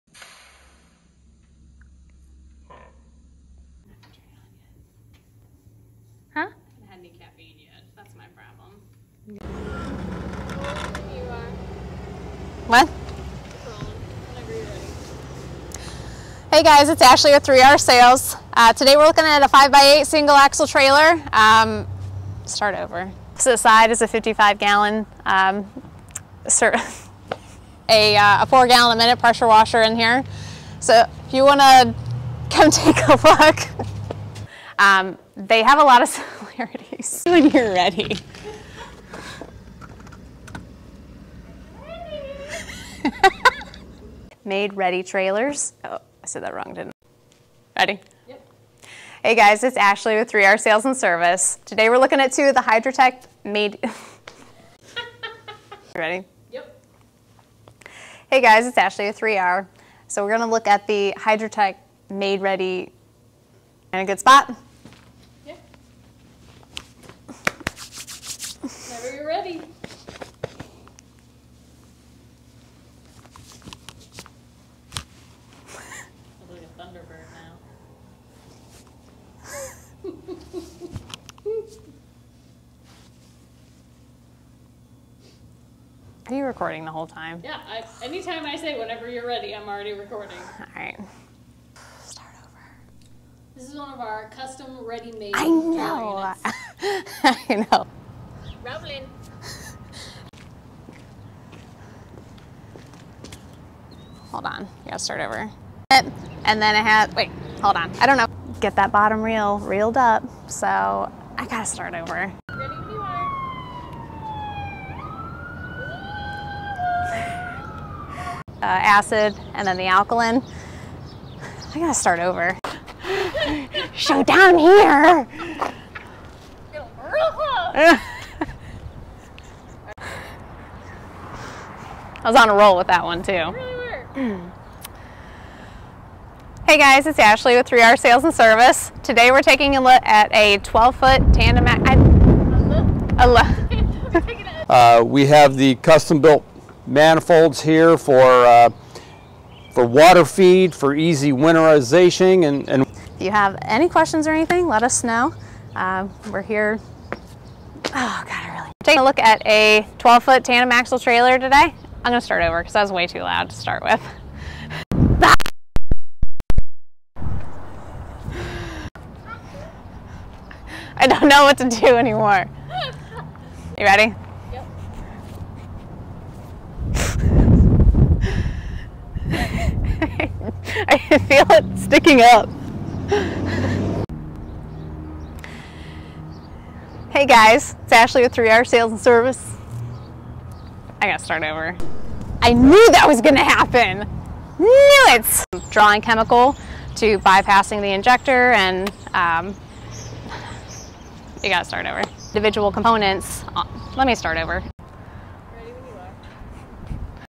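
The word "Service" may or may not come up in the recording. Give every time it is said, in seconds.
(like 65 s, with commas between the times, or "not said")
50 s, 138 s, 188 s.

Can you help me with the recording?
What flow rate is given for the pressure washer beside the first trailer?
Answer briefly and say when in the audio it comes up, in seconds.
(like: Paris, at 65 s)
4 gallons a minute, at 28 s.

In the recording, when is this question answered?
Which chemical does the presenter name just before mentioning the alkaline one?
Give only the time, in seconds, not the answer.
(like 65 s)
118 s.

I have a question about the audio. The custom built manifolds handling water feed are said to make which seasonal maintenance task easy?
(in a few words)
winterization.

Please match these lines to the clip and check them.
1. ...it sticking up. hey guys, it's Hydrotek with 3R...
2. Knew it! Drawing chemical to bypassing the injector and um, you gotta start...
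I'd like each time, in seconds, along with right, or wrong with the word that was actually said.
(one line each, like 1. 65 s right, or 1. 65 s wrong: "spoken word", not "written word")
1. 181 s wrong: "Ashley", not "Hydrotek"
2. 194 s right.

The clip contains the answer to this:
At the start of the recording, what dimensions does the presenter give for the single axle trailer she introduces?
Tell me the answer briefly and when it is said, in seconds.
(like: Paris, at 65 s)
5x8, at 19 s.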